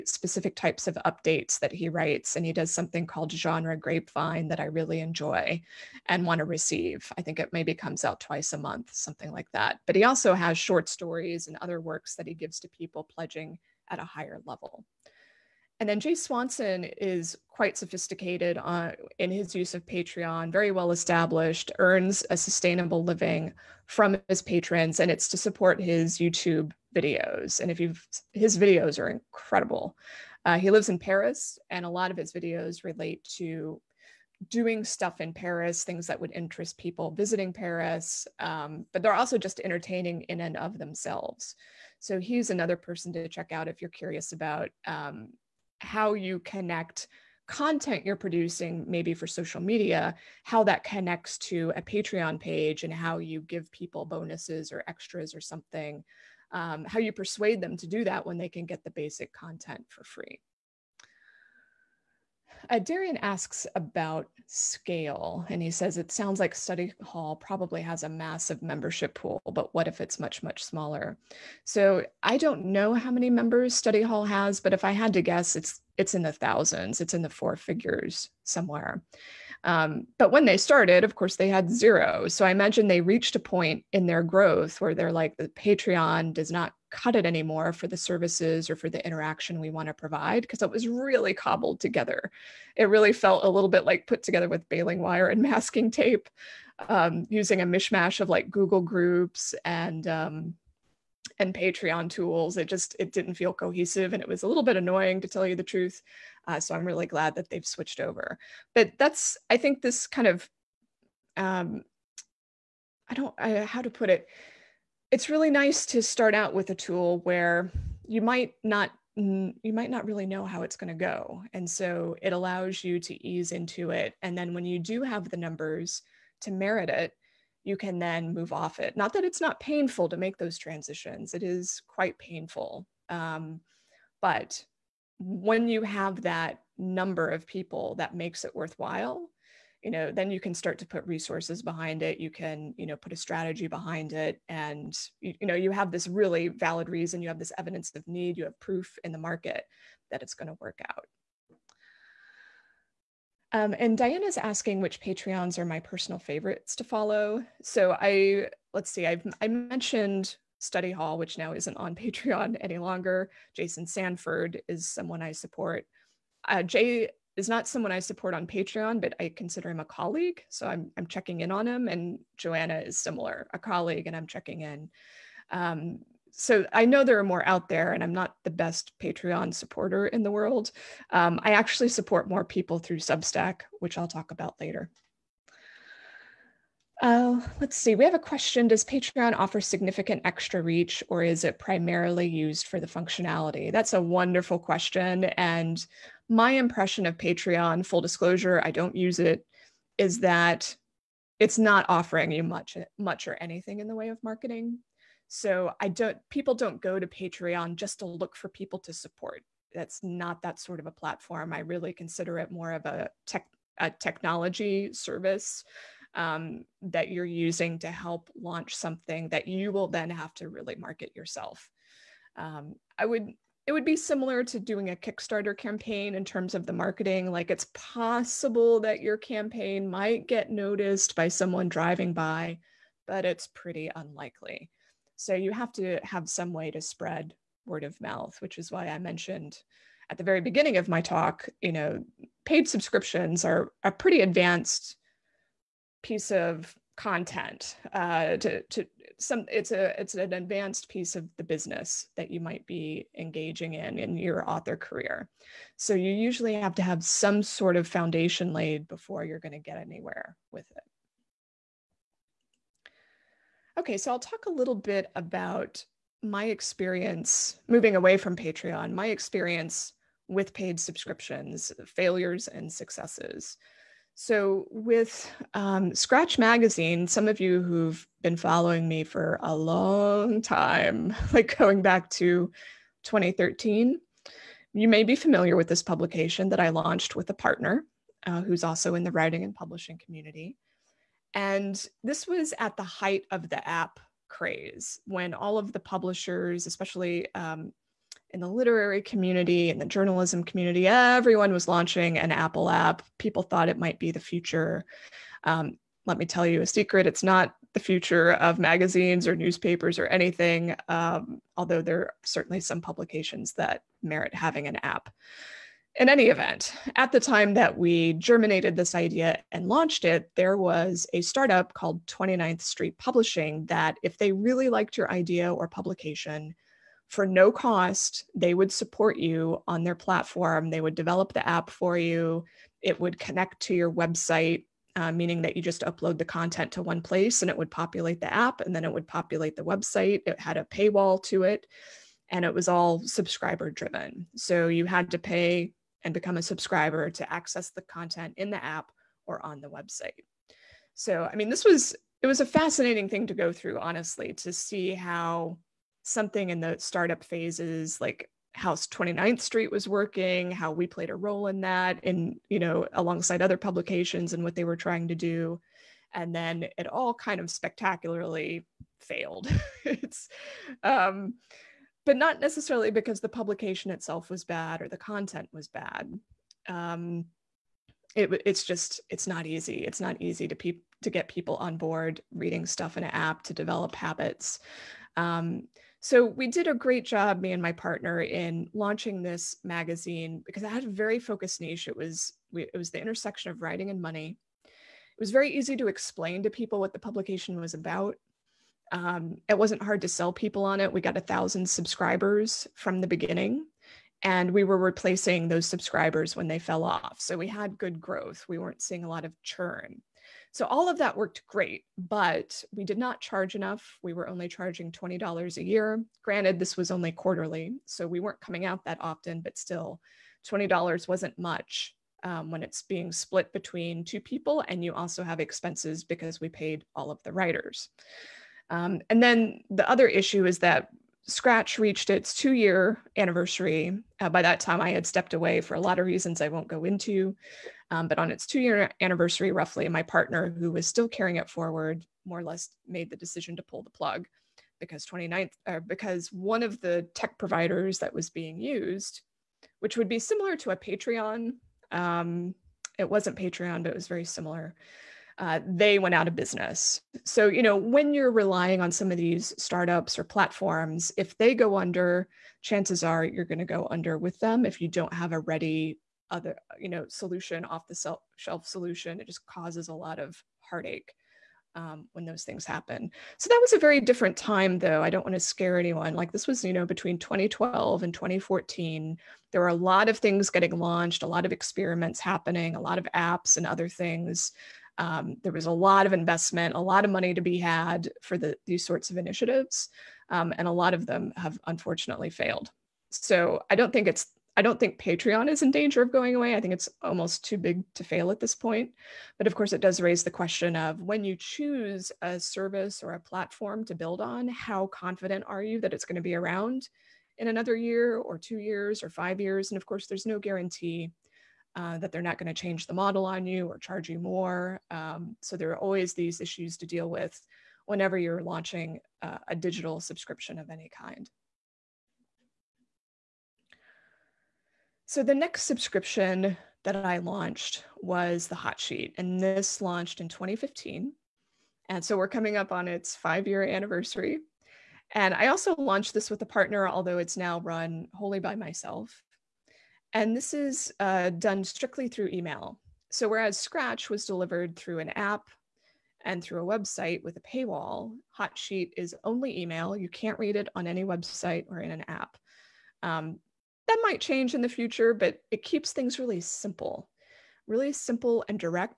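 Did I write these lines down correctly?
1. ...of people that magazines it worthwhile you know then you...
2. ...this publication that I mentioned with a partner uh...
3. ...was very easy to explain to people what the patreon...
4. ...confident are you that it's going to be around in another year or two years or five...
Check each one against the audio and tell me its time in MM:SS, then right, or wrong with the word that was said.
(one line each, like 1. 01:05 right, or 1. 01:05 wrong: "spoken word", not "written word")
1. 02:17 wrong: "makes", not "magazines"
2. 04:45 wrong: "launched", not "mentioned"
3. 06:35 wrong: "publication", not "patreon"
4. 08:24 right.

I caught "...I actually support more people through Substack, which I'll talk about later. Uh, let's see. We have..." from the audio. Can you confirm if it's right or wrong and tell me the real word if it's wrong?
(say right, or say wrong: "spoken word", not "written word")
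right.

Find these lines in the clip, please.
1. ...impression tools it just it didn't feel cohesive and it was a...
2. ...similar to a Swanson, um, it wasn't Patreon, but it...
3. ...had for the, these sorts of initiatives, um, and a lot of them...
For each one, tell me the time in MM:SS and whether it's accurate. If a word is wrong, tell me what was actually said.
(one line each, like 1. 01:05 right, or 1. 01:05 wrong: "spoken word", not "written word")
1. 01:41 wrong: "patreon", not "impression"
2. 07:30 wrong: "Patreon", not "Swanson"
3. 08:07 right.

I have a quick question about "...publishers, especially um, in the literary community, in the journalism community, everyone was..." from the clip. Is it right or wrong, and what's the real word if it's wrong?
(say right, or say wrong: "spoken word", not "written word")
right.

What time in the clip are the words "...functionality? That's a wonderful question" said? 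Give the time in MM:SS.
03:12.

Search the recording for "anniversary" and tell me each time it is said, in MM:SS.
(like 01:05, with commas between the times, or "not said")
07:13, 07:19, 08:53.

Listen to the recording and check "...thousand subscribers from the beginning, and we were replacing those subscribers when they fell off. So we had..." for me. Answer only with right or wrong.
right.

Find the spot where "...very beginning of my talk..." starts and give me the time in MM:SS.
04:00.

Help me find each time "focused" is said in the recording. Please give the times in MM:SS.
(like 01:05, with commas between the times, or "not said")
06:31.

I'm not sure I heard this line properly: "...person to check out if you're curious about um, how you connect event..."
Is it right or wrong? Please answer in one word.
wrong.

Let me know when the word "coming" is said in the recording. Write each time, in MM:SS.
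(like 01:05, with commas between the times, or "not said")
06:58, 08:52.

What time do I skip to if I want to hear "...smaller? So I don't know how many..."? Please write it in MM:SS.
01:10.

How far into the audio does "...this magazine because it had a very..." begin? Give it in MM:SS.
06:29.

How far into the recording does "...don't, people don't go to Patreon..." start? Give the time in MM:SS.
03:25.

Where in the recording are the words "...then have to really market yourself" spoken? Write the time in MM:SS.
03:39.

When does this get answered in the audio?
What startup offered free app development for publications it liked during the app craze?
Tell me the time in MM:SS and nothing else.
05:22.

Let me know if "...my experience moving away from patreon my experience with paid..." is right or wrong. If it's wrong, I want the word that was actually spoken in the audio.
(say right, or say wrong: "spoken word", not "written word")
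right.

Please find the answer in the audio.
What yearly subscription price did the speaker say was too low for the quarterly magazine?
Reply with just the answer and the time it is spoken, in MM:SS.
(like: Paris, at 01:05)
$20, at 06:54.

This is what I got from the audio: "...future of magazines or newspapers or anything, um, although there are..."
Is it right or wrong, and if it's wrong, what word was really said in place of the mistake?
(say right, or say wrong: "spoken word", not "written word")
right.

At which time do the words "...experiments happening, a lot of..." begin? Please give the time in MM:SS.
08:01.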